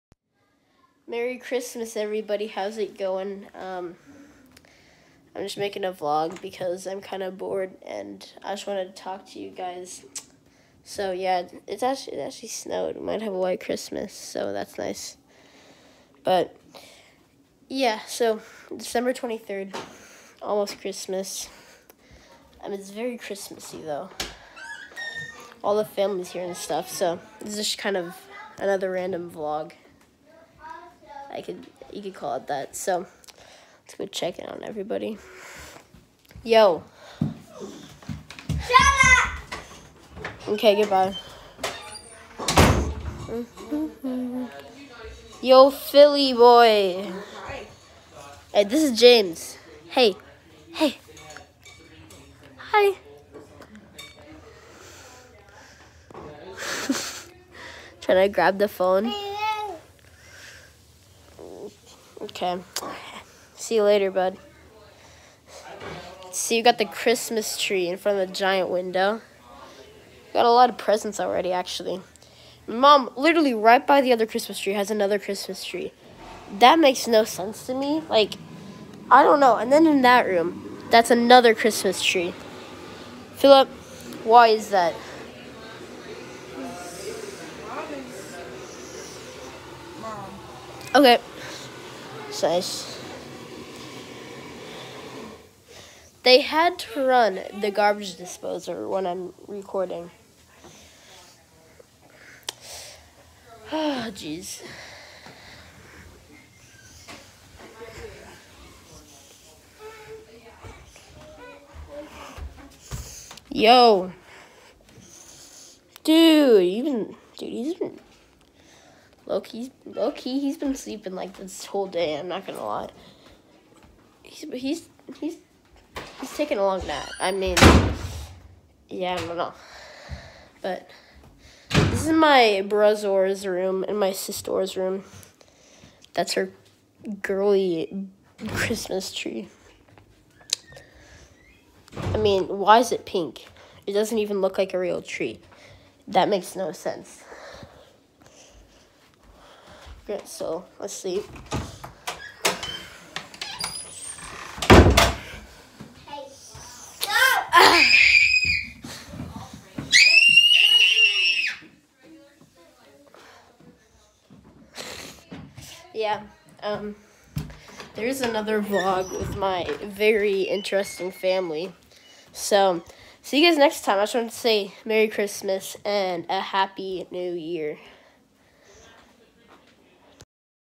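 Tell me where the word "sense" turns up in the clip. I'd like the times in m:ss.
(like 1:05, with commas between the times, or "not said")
1:17, 2:26.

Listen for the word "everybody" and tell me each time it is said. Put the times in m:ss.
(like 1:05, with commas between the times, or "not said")
0:01, 0:34.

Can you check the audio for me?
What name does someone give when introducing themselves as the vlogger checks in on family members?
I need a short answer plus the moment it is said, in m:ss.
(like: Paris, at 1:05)
James, at 0:48.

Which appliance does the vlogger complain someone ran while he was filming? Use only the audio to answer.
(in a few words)
garbage disposer.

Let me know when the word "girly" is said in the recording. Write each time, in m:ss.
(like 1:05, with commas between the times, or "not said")
2:17.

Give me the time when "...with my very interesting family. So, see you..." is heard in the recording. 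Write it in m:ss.
2:49.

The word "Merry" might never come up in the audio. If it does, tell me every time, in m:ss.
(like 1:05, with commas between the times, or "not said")
0:01, 2:54.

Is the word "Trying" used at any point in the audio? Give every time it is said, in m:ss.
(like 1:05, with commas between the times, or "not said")
0:58.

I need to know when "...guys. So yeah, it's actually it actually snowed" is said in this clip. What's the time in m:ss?
0:09.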